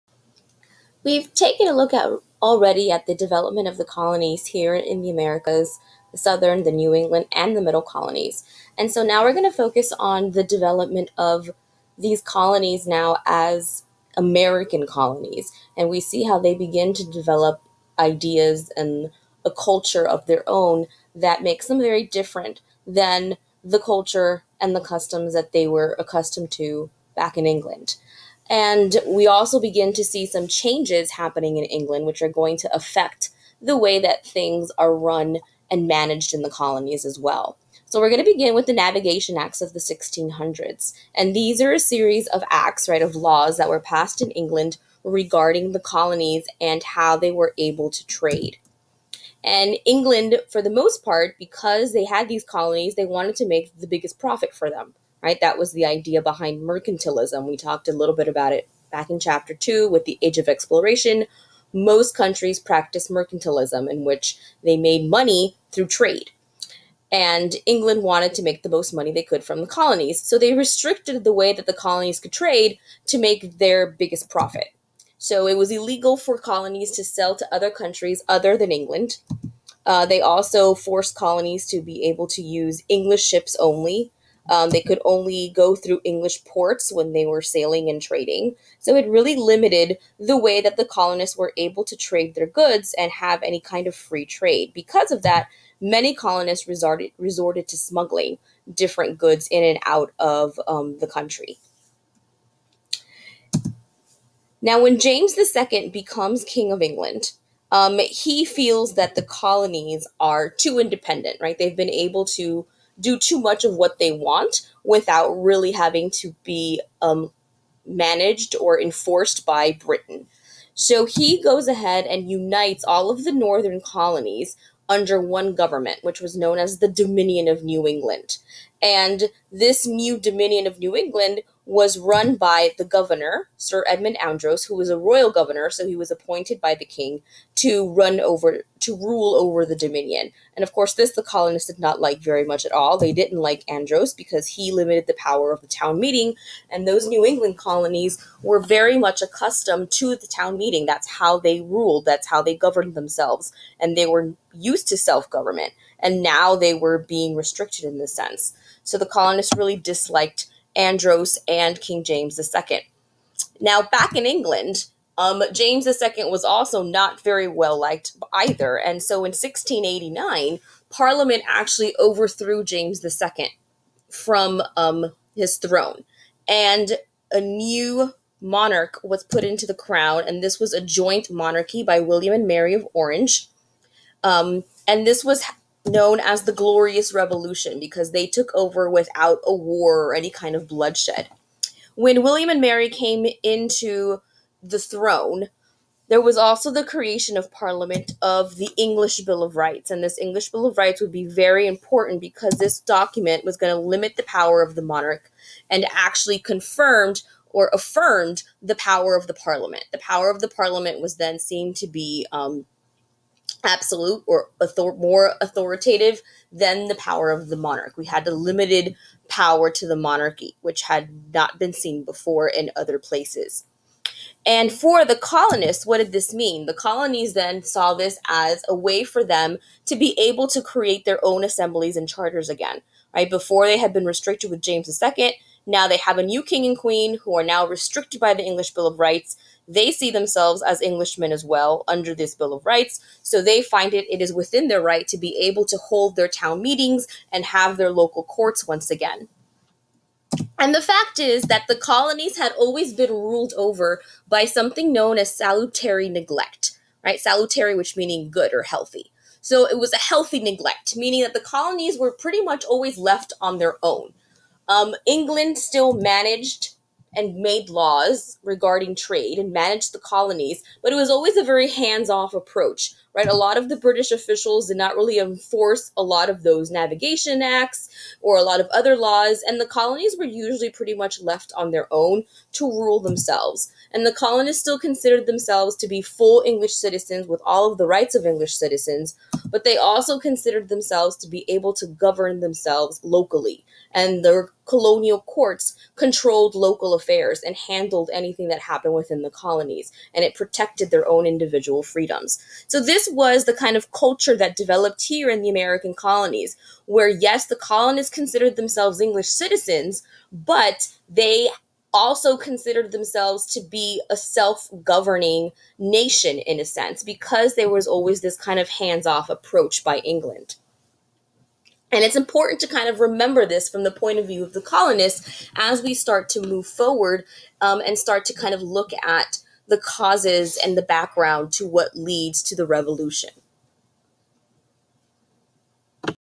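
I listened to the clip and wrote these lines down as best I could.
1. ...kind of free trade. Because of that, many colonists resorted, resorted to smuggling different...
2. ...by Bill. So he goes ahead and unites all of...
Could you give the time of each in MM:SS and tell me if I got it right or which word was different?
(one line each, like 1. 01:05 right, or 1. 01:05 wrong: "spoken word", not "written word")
1. 01:33 right
2. 01:59 wrong: "Britain", not "Bill".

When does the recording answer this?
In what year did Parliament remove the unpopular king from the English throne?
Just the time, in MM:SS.
02:49.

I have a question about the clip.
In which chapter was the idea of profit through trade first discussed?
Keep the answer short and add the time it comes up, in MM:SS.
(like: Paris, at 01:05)
chapter two, at 00:59.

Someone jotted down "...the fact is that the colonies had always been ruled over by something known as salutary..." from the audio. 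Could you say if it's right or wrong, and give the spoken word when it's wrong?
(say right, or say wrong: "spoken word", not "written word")
right.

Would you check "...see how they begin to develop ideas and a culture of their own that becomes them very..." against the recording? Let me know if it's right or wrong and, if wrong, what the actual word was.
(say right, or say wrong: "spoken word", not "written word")
wrong: "makes", not "becomes".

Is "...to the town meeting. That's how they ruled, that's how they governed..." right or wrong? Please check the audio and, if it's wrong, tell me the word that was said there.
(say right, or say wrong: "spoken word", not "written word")
right.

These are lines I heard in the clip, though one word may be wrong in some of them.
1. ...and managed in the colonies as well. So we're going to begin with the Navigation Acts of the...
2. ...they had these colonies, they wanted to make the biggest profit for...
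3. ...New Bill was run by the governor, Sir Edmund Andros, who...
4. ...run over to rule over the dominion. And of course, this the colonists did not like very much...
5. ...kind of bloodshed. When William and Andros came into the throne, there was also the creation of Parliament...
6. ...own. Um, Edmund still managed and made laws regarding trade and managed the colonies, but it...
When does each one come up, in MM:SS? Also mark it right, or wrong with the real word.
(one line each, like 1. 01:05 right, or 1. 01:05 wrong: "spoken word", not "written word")
1. 00:35 right
2. 00:51 right
3. 02:10 wrong: "England", not "Bill"
4. 02:17 right
5. 03:10 wrong: "Mary", not "Andros"
6. 04:23 wrong: "England", not "Edmund".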